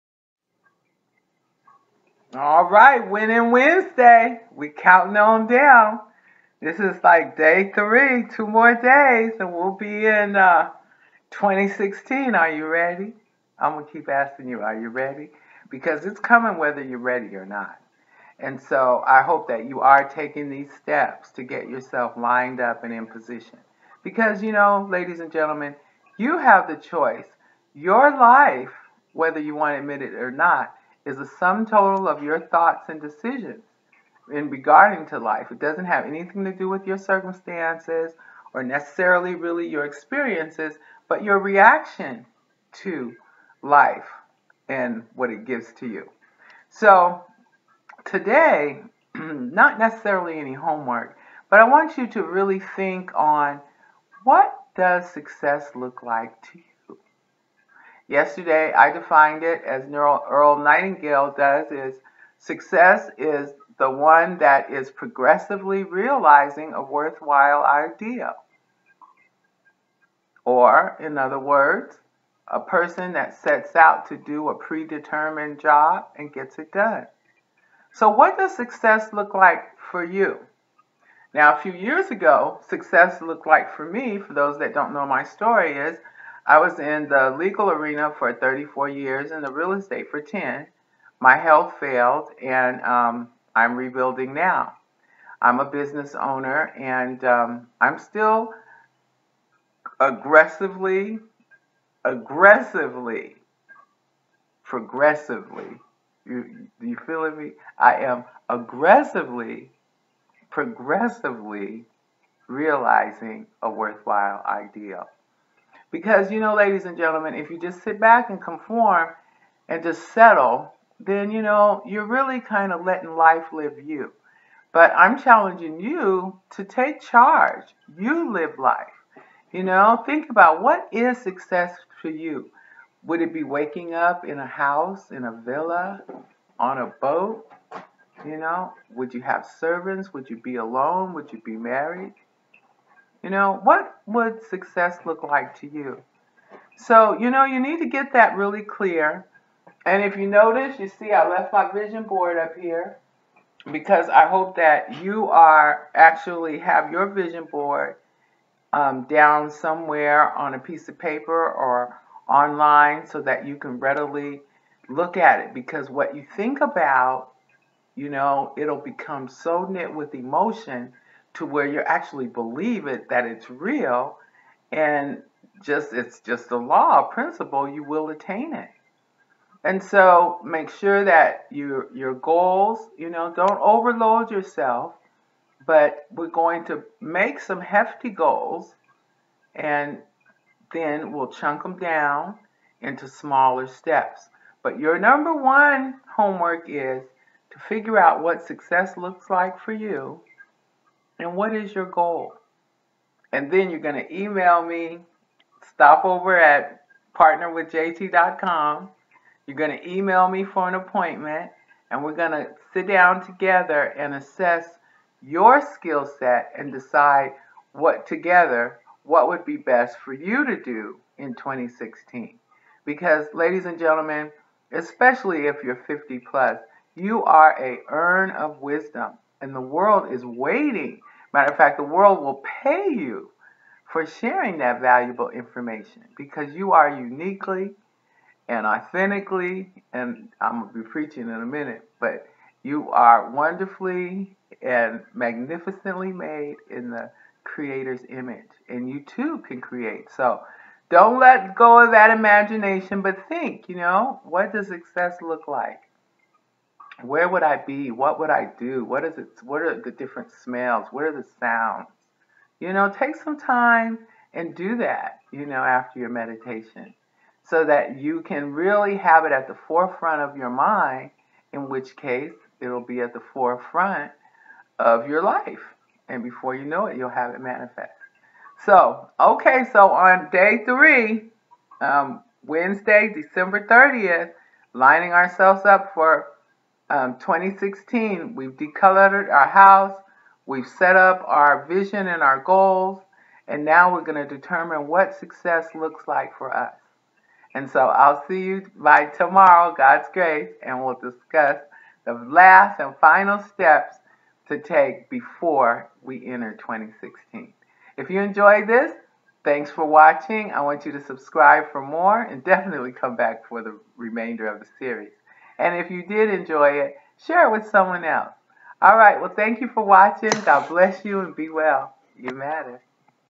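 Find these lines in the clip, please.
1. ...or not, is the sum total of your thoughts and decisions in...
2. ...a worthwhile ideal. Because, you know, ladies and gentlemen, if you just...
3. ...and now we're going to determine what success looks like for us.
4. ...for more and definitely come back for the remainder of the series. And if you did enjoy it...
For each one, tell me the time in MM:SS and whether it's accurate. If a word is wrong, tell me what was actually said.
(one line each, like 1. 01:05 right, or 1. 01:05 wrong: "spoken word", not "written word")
1. 00:30 right
2. 01:53 right
3. 04:53 right
4. 05:11 right.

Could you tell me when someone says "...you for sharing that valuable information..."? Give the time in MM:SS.
03:52.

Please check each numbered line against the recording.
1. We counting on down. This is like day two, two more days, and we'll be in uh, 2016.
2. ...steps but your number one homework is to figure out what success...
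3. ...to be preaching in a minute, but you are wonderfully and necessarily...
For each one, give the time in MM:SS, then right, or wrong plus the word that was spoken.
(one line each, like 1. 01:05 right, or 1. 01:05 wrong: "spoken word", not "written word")
1. 00:04 wrong: "three", not "two"
2. 03:13 right
3. 04:00 wrong: "magnificently", not "necessarily".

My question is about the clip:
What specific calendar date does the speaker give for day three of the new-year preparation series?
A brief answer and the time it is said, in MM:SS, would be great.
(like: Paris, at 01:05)
Wednesday, December 30th, at 04:42.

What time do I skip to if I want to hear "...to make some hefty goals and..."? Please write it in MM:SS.
03:06.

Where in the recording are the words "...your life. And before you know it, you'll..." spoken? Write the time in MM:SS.
04:35.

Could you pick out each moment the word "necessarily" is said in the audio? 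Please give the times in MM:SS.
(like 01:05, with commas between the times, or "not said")
00:38, 00:49.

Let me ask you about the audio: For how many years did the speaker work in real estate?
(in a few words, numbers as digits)
10.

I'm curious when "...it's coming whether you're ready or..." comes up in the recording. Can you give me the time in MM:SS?
00:16.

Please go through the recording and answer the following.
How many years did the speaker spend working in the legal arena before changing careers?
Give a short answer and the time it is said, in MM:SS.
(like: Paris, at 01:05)
34, at 01:28.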